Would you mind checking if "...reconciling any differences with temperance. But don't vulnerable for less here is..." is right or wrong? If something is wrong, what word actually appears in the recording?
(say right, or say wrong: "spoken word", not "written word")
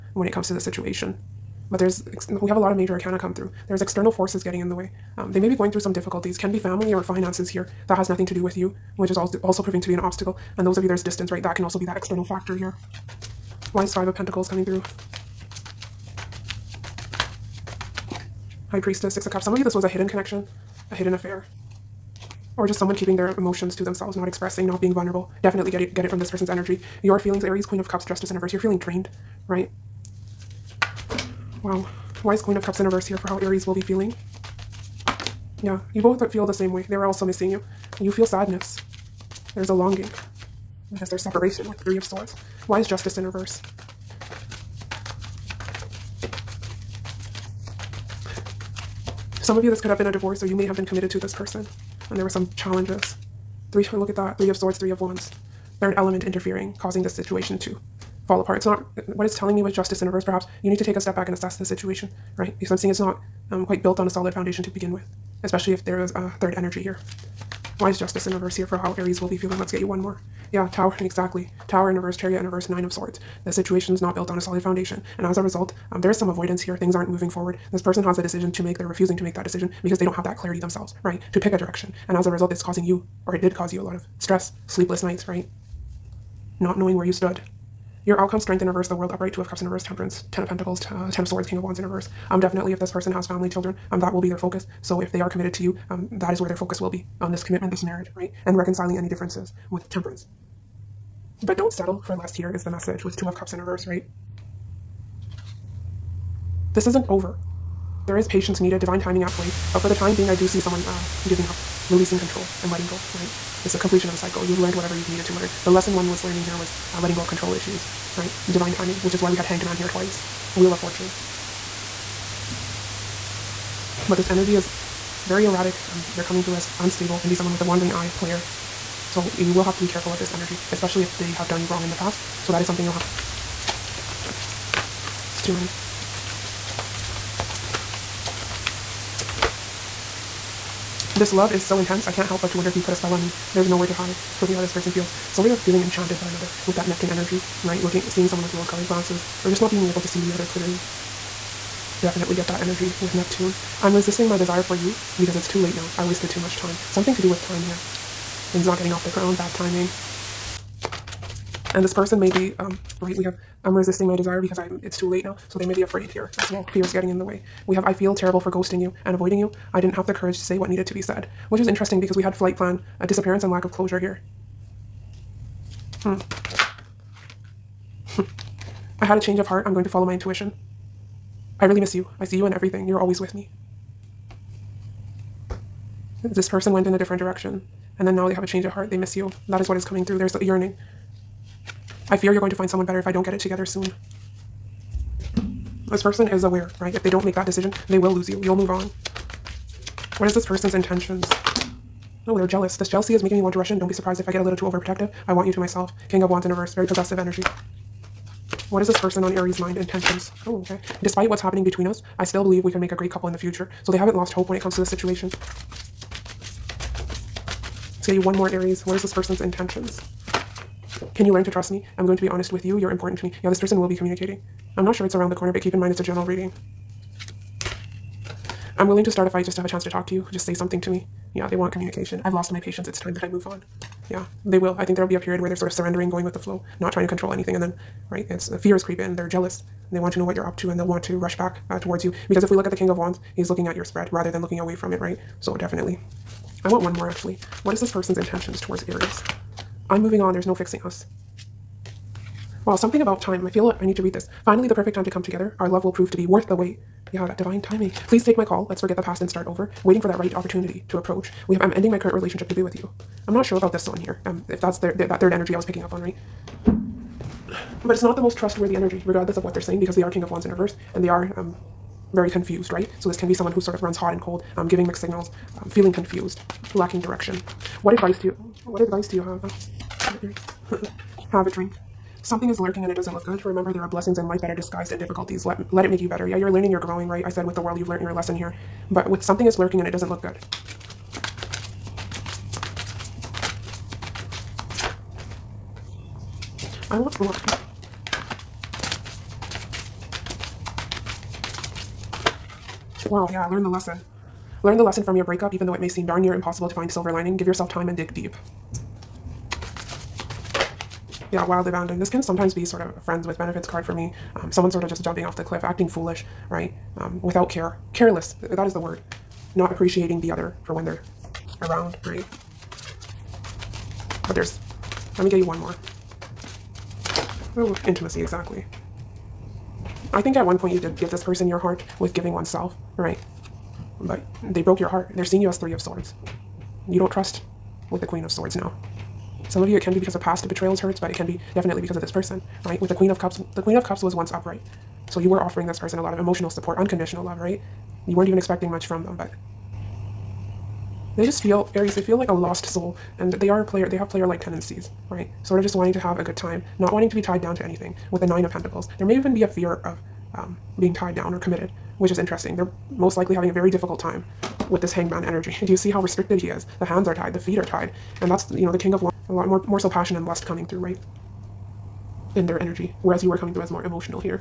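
wrong: "settle", not "vulnerable".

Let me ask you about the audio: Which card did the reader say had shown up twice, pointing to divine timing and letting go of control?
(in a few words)
Hanged Man.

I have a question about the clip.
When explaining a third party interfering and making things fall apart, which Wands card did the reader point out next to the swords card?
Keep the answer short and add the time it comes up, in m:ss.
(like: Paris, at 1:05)
Three of Wands, at 0:54.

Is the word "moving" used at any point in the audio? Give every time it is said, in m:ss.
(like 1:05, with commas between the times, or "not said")
1:17, 4:10.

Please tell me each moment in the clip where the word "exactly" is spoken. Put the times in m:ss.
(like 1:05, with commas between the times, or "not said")
1:10, 5:28.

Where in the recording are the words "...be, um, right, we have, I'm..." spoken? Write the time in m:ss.
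2:42.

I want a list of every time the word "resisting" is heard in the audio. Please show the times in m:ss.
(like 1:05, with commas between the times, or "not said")
2:33, 2:43.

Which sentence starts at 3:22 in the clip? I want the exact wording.
This jealousy is making me want to rush in.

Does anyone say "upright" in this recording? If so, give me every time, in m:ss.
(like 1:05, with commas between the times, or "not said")
1:29, 5:44.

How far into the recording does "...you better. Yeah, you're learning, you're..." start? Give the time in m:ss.
4:46.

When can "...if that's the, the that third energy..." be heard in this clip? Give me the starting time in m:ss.
4:24.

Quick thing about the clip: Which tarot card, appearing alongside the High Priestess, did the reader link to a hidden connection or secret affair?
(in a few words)
Six of Cups.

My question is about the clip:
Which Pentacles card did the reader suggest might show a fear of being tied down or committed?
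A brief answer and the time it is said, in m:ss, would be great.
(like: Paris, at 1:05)
Nine of Pentacles, at 5:58.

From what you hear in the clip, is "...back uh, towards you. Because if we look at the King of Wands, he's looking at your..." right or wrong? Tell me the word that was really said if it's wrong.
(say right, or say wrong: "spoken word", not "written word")
right.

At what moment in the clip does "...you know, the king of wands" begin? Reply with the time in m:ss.
6:08.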